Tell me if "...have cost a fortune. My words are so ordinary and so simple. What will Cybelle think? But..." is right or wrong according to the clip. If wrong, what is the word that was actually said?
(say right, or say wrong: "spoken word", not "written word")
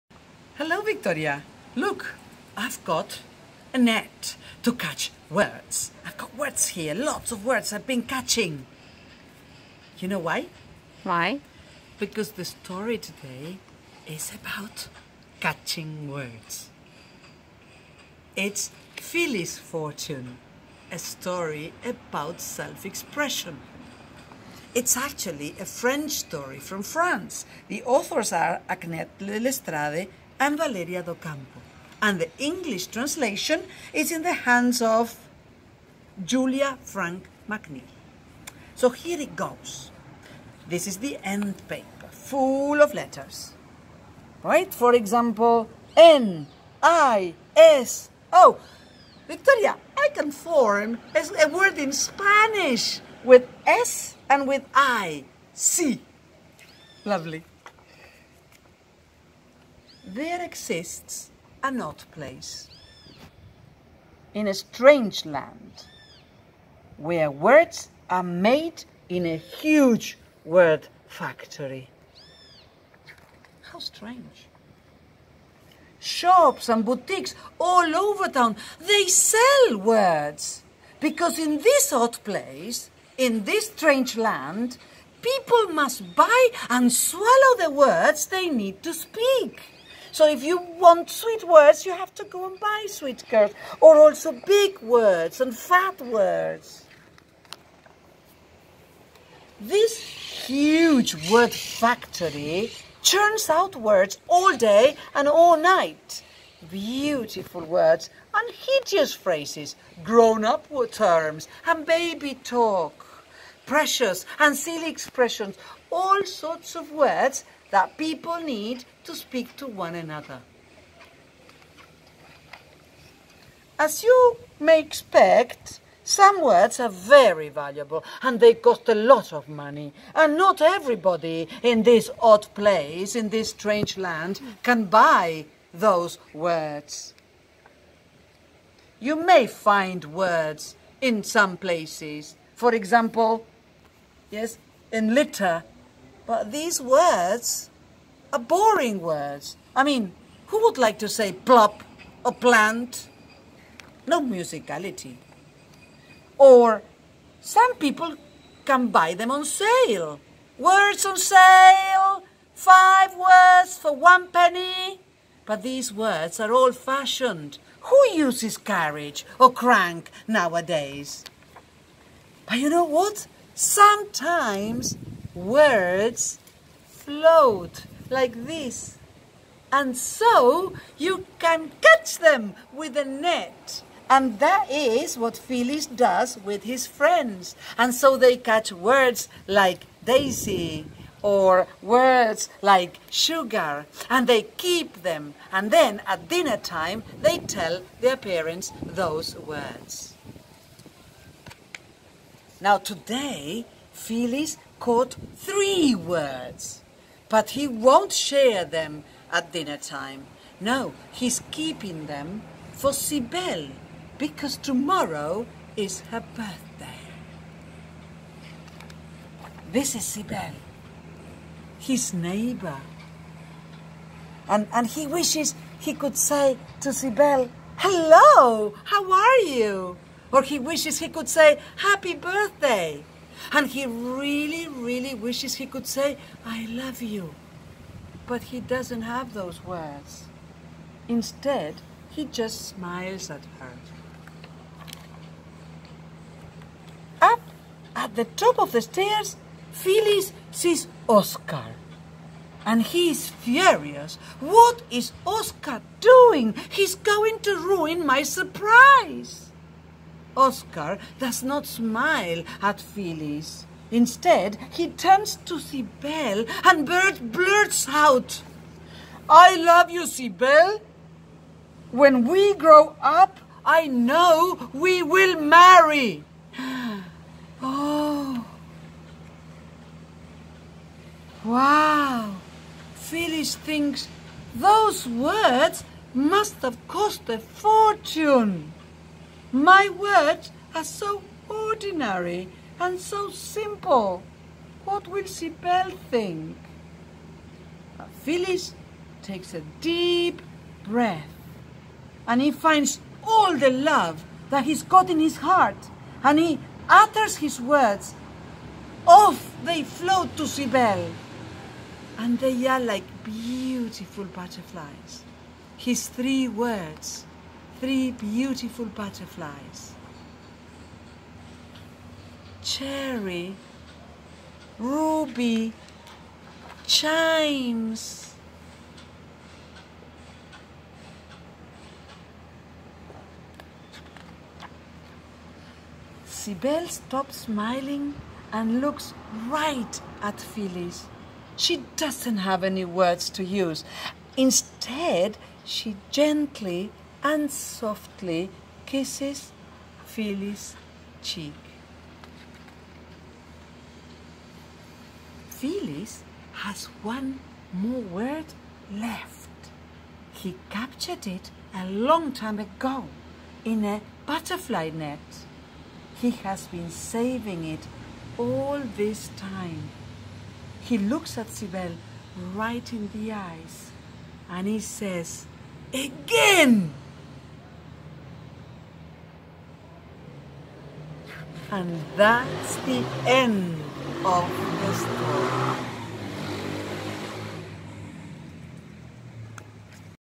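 right.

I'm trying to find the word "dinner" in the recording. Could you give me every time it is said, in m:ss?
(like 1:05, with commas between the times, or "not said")
3:16, 3:29.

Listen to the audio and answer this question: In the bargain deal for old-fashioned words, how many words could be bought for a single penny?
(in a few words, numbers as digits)
5.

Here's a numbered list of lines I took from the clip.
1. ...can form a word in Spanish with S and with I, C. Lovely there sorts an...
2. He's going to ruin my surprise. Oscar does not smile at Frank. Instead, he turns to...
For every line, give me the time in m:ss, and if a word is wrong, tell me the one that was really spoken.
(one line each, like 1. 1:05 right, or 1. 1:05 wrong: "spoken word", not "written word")
1. 0:50 wrong: "exists", not "sorts"
2. 4:16 wrong: "Phileas", not "Frank".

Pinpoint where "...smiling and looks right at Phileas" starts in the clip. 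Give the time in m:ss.
5:37.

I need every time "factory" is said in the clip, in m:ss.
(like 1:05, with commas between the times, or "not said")
1:11, 1:41.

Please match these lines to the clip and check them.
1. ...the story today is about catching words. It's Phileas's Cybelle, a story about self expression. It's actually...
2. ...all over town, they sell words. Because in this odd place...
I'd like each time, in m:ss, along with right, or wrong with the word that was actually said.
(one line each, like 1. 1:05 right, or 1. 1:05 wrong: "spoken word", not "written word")
1. 0:12 wrong: "Fortune", not "Cybelle"
2. 1:17 right.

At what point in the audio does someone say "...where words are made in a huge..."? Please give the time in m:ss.
1:06.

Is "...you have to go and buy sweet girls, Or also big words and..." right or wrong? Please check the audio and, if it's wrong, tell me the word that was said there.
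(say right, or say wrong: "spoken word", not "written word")
right.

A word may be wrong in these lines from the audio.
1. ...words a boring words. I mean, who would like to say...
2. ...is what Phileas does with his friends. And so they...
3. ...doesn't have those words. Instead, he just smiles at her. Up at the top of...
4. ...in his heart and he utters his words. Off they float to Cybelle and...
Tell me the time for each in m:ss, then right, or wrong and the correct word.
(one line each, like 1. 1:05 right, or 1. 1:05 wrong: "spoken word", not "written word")
1. 2:26 right
2. 3:04 right
3. 3:58 right
4. 5:05 right.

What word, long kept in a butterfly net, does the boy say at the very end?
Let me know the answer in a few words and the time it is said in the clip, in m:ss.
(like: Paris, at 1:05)
Again, at 6:15.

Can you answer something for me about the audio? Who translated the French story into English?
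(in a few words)
Julia Frank McNeil.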